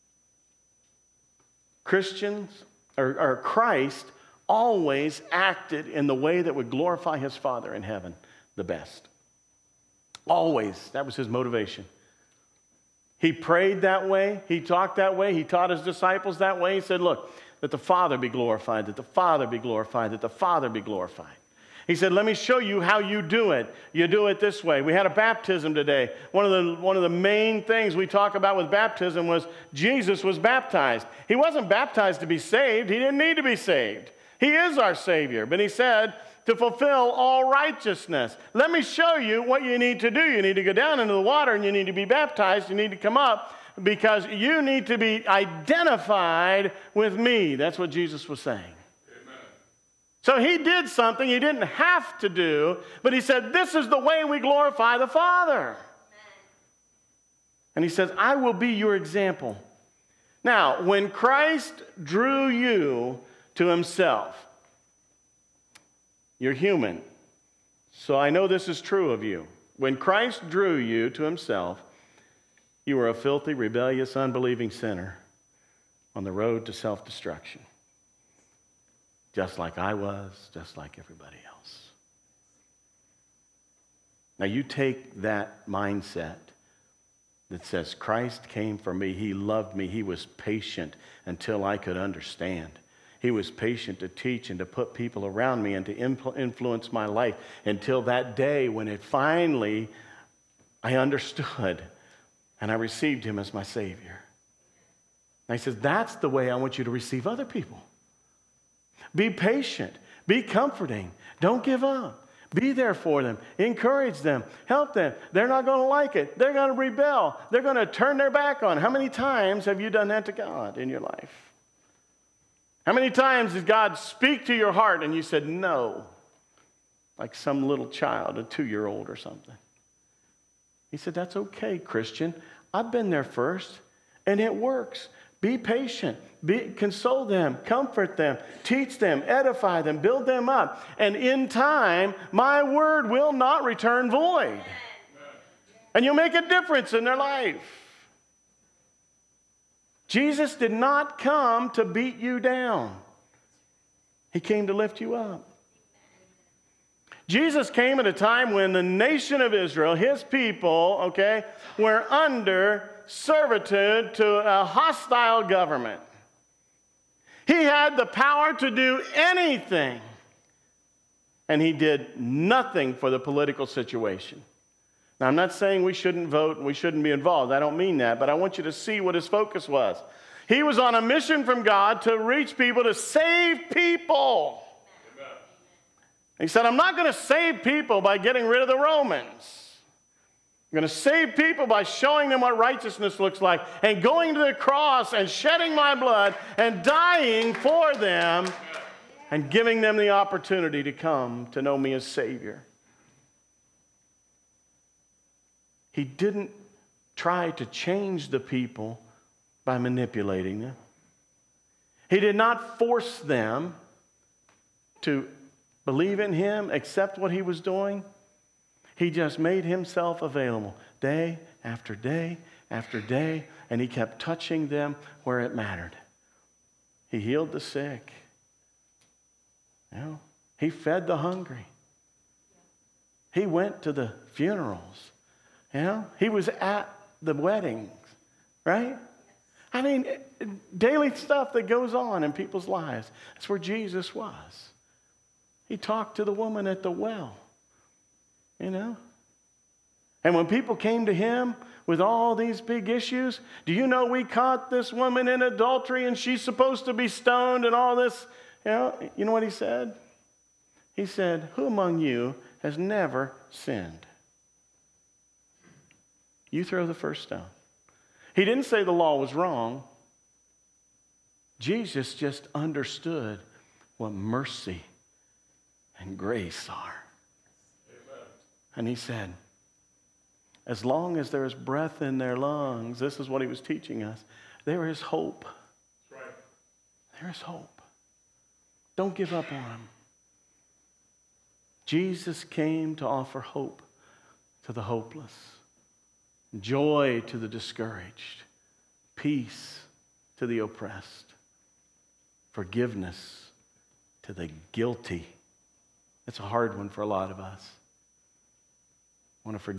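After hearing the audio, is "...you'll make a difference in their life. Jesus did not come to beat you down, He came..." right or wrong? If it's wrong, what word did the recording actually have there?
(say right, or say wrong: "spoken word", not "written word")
right.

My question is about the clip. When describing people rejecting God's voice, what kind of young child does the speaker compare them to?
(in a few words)
A two year old.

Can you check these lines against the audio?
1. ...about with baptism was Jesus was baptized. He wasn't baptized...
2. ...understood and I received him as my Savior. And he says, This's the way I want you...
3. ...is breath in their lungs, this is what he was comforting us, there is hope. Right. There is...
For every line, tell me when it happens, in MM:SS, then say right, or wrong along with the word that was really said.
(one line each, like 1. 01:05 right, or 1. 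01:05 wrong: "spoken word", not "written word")
1. 00:28 right
2. 01:40 wrong: "That", not "This"
3. 04:41 wrong: "teaching", not "comforting".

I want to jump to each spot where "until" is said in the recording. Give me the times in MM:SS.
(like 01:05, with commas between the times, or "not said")
01:31, 01:37.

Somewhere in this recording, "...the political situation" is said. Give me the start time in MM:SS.
02:53.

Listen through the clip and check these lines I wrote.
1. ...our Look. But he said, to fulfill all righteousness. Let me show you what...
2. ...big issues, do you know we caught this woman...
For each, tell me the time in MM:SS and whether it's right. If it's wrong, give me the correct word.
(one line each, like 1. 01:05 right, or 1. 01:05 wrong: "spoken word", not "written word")
1. 00:34 wrong: "Savior", not "Look"
2. 04:12 right.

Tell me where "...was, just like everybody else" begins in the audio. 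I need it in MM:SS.
01:19.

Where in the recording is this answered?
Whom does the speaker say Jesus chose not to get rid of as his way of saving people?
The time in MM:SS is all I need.
03:08.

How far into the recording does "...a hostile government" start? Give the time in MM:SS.
02:44.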